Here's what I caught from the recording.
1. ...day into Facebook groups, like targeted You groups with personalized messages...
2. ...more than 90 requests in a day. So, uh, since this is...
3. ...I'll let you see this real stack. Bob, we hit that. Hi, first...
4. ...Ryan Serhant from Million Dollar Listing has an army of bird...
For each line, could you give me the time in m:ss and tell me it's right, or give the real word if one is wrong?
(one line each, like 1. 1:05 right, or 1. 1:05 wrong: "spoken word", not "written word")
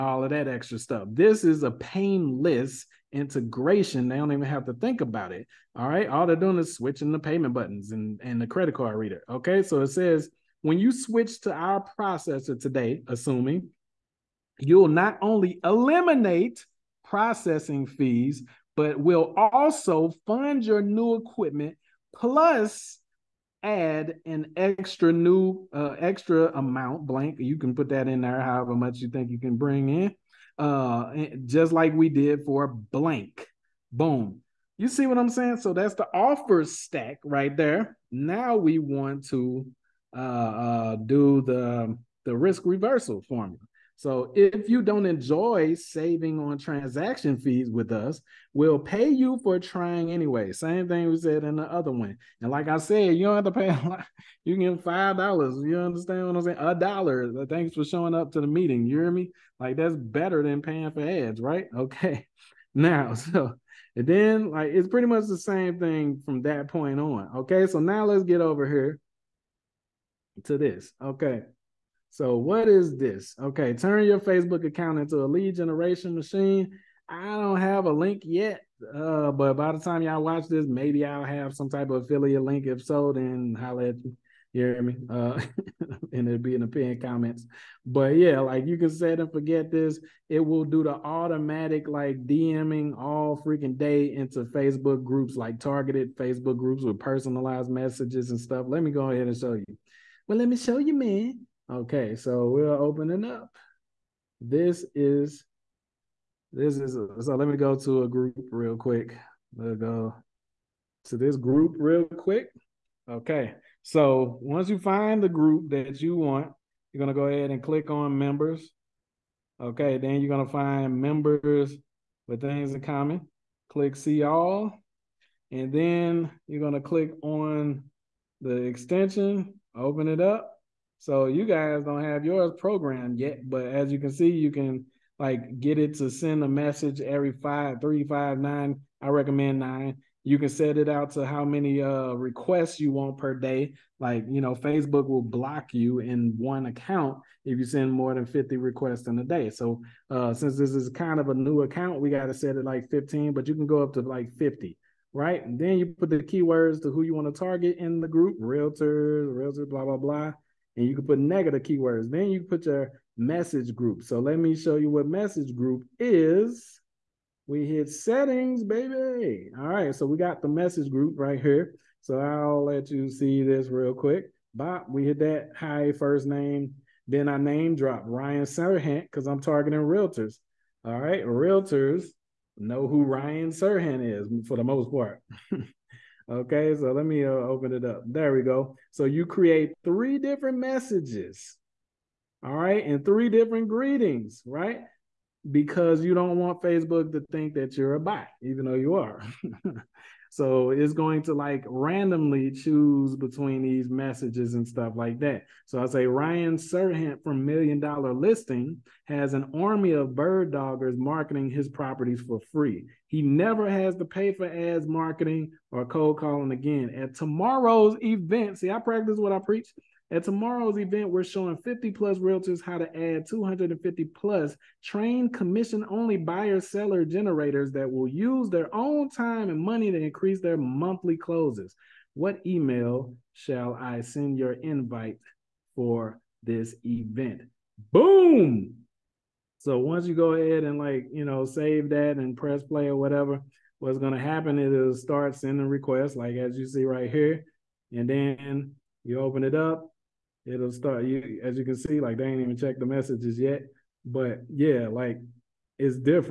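1. 1:33 wrong: "Facebook", not "You"
2. 2:27 wrong: "50", not "90"
3. 2:52 wrong: "quick", not "stack"
4. 3:26 right.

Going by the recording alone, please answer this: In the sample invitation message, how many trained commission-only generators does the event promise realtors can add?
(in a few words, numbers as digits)
250+.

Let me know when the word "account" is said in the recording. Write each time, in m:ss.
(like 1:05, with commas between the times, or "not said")
1:14, 2:26, 2:31.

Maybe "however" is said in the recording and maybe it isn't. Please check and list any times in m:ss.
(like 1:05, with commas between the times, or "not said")
0:28.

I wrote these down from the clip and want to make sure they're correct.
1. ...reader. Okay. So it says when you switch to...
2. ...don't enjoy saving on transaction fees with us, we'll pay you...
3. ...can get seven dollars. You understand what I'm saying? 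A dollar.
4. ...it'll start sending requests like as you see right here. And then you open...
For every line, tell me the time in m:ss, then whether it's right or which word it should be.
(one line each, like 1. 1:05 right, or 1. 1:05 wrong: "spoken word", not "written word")
1. 0:08 right
2. 0:44 right
3. 0:54 wrong: "five", not "seven"
4. 4:04 right.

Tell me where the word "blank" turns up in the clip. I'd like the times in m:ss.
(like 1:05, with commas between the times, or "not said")
0:27, 0:32.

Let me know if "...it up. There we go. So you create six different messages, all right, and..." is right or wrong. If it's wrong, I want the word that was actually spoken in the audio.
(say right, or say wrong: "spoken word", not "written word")
wrong: "three", not "six".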